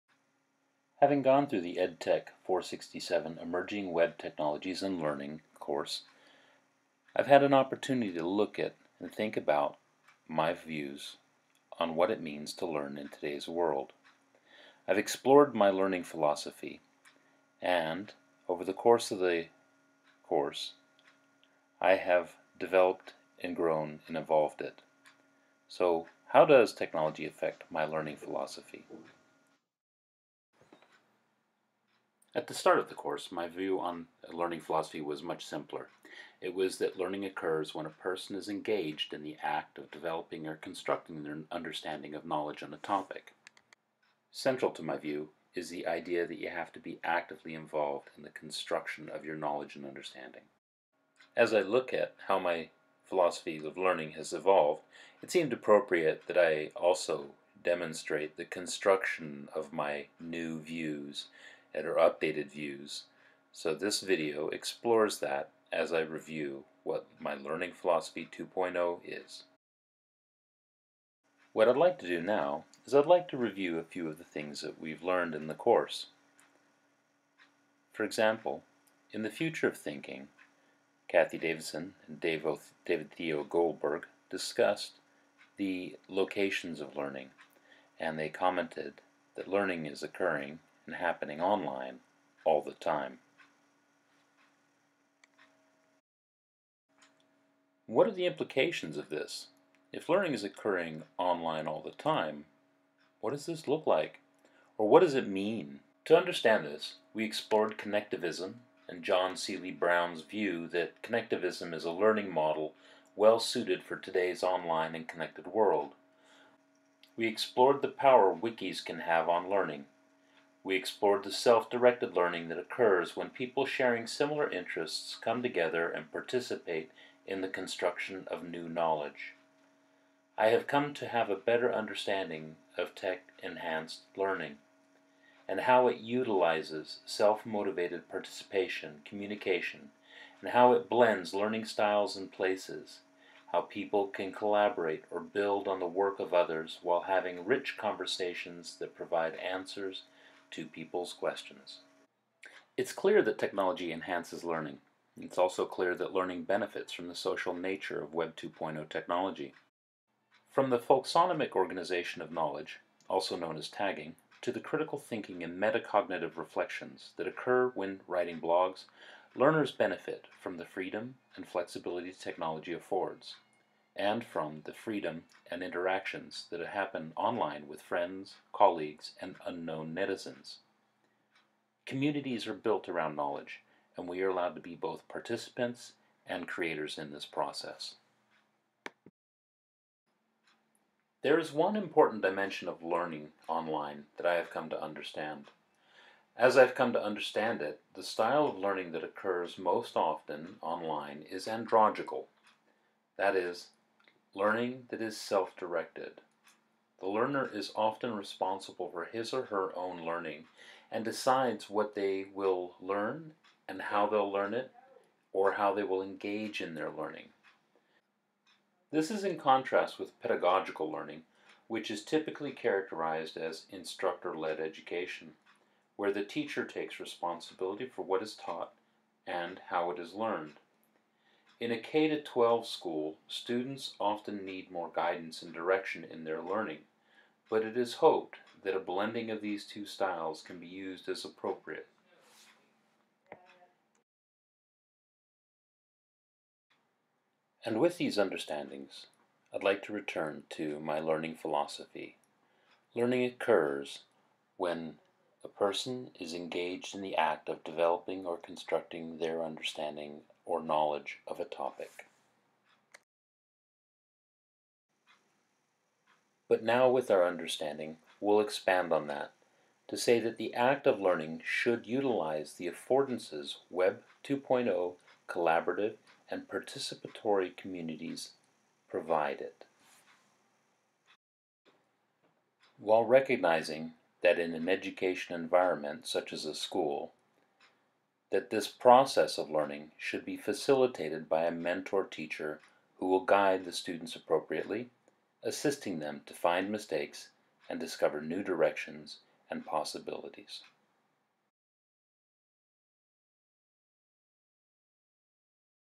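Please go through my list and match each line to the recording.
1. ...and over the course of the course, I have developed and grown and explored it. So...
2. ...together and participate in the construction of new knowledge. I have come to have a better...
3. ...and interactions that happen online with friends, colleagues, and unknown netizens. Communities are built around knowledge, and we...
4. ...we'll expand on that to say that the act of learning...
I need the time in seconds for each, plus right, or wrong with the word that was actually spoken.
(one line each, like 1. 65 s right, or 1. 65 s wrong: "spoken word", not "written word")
1. 17 s wrong: "evolved", not "explored"
2. 125 s right
3. 175 s right
4. 268 s right.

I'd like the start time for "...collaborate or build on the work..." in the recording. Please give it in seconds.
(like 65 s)
144 s.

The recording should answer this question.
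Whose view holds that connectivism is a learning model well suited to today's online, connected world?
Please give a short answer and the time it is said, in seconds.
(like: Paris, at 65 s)
John Seeley Brown, at 109 s.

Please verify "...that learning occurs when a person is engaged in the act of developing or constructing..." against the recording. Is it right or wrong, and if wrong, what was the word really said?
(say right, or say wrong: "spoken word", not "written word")
right.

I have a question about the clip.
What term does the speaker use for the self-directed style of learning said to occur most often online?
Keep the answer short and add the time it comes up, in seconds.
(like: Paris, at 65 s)
andragogical, at 201 s.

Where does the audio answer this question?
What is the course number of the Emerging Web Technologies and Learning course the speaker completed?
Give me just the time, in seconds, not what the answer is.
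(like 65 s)
1 s.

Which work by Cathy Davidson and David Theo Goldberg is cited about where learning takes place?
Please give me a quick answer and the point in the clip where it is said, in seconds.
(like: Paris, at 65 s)
The Future of Thinking, at 79 s.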